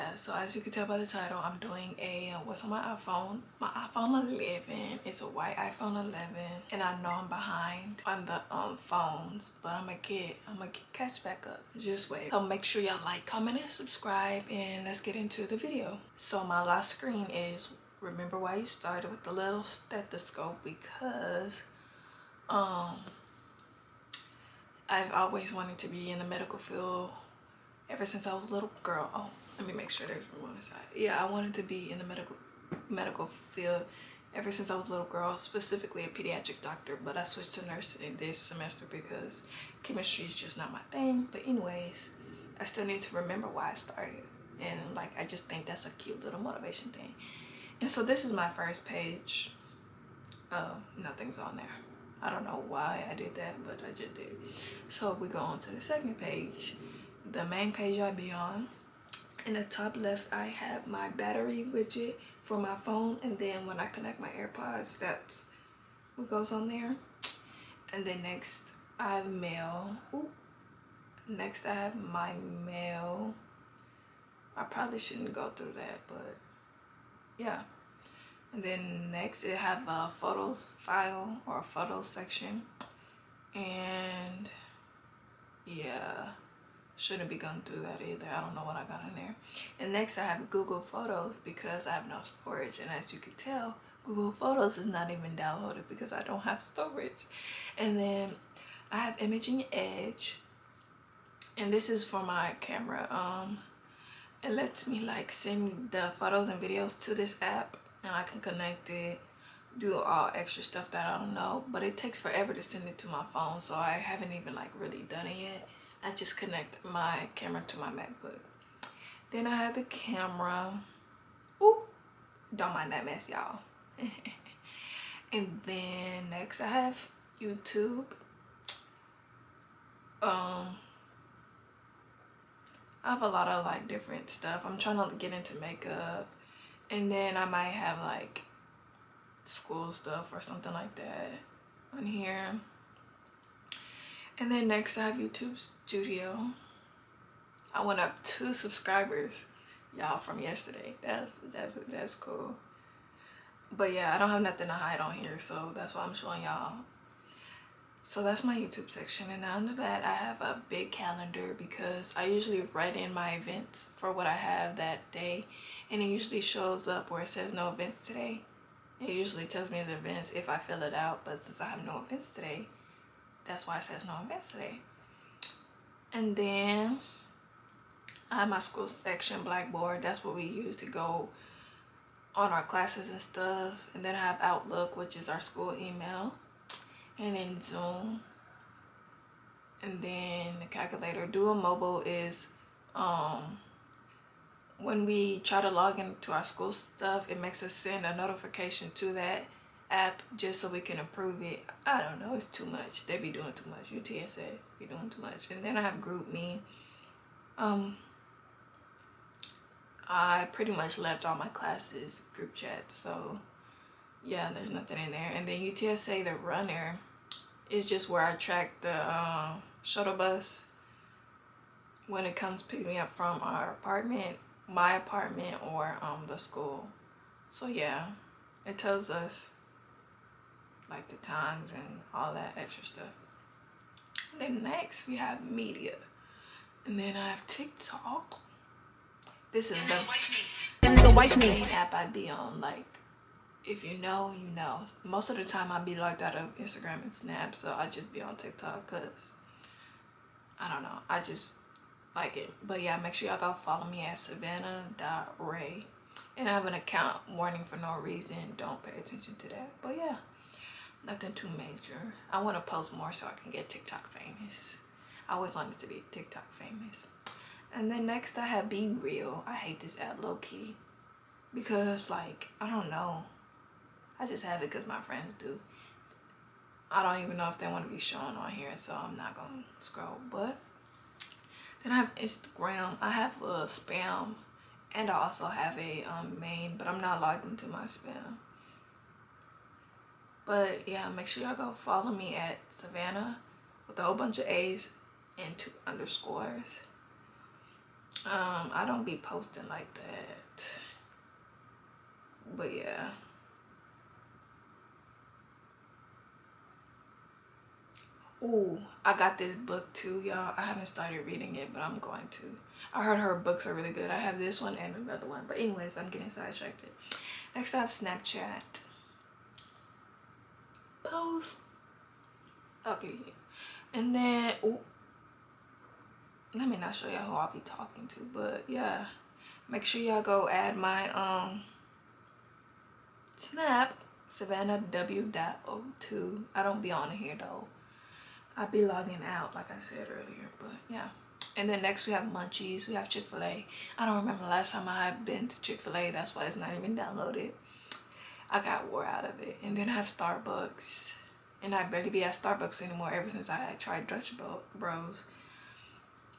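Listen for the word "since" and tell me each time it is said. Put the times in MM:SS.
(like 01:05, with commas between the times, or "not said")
00:28, 00:34, 02:51, 05:53.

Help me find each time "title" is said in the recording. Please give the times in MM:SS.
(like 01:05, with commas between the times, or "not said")
00:01.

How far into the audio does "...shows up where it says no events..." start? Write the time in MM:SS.
02:46.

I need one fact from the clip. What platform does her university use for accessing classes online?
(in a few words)
Blackboard.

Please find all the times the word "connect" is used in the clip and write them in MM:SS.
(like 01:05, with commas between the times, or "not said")
01:03, 01:48, 01:56.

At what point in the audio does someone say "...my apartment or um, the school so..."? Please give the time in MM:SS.
03:44.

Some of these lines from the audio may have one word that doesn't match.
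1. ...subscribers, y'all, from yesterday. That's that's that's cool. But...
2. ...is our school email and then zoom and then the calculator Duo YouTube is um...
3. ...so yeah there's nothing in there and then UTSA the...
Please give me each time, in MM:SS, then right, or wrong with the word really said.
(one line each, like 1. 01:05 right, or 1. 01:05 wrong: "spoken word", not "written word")
1. 02:28 right
2. 03:05 wrong: "Mobile", not "YouTube"
3. 03:32 right.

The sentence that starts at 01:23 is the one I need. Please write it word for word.
And yeah, shouldn't be going through that either.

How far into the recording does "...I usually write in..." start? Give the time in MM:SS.
02:42.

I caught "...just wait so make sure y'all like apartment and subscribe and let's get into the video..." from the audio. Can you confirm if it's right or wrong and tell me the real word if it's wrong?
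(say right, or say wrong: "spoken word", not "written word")
wrong: "comment", not "apartment".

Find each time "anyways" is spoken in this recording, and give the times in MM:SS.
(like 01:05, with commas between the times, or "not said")
00:41, 05:15.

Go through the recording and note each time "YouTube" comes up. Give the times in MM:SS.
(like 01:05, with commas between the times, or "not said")
02:07, 02:25, 02:38.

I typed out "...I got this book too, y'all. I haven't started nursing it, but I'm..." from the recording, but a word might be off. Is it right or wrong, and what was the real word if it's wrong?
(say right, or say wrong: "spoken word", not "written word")
wrong: "reading", not "nursing".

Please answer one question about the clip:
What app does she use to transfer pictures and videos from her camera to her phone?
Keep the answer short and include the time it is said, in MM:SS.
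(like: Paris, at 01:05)
Imaging Edge, at 01:39.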